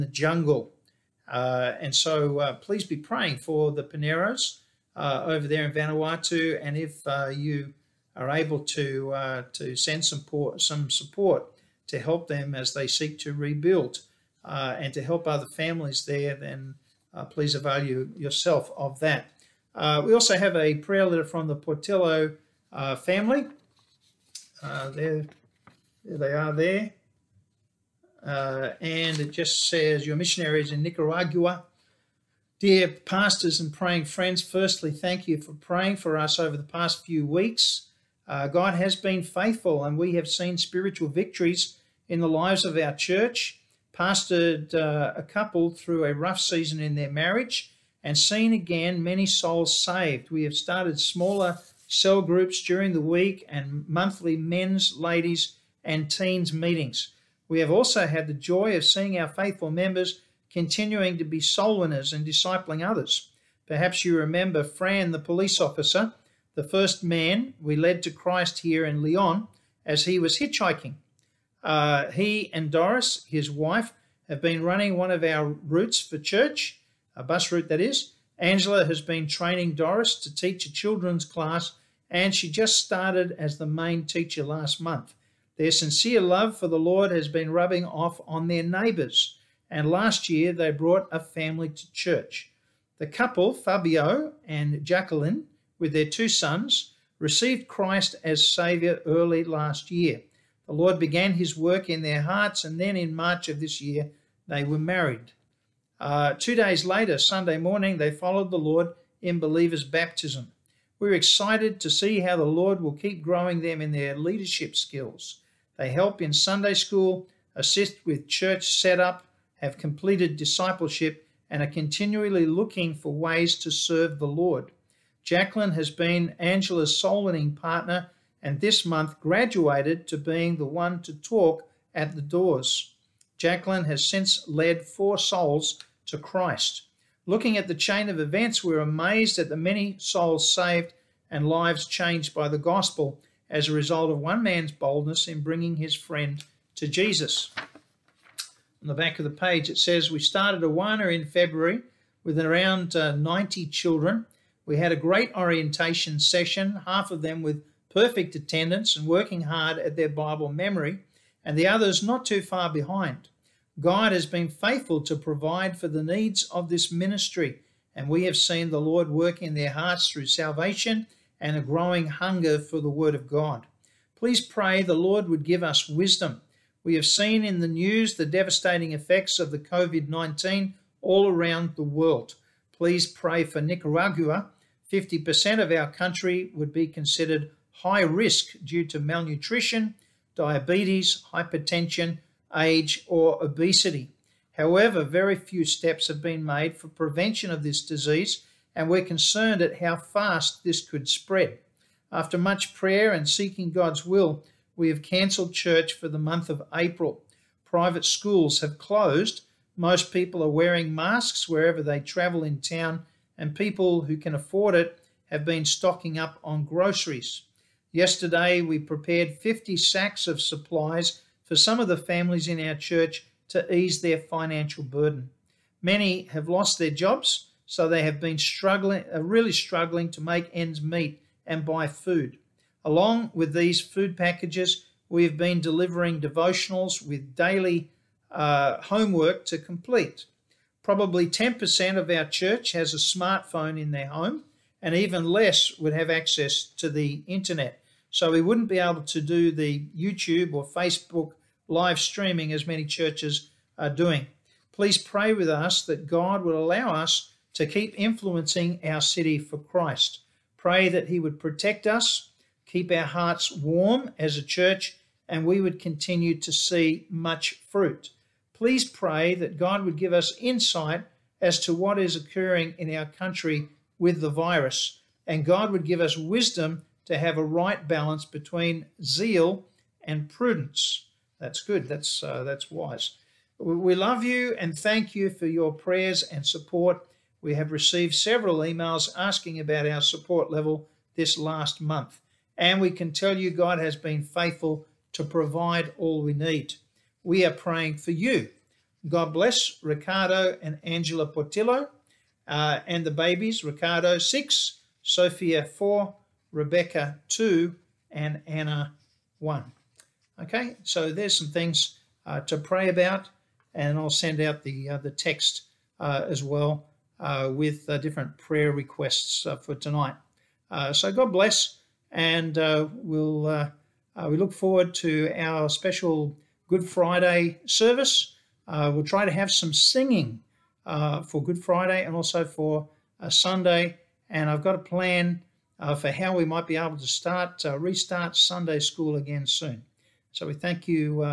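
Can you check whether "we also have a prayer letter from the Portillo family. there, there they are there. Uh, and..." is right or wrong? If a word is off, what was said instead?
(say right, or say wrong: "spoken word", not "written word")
right.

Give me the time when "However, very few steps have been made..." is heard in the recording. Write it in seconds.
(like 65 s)
194 s.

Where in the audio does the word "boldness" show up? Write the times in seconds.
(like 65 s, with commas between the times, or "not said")
144 s.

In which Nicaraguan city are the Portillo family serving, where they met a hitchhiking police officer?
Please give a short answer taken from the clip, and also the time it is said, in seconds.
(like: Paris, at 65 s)
León, at 69 s.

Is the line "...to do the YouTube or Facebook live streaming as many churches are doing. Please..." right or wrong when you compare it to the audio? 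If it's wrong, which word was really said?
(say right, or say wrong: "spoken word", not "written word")
right.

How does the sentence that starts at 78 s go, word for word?
Angela has been training Doris to teach a children's class, and she just started as the main teacher last month.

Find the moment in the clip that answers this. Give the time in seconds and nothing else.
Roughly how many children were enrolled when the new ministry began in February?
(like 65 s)
153 s.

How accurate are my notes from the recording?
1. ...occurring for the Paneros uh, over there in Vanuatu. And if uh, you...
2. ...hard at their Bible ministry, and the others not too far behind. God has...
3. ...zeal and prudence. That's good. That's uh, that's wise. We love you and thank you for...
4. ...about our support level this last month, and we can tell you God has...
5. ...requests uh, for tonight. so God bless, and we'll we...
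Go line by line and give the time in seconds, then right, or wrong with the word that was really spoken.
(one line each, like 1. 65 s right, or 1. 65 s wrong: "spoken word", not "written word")
1. 2 s wrong: "praying", not "occurring"
2. 159 s wrong: "memory", not "ministry"
3. 279 s right
4. 289 s right
5. 318 s right.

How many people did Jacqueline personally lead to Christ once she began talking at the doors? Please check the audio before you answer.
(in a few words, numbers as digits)
4.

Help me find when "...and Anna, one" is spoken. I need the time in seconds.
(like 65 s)
308 s.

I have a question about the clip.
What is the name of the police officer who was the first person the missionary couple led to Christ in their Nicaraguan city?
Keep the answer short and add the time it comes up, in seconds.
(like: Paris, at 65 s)
Fran, at 64 s.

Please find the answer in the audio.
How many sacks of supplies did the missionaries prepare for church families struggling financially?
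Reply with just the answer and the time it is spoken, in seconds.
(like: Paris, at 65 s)
50, at 219 s.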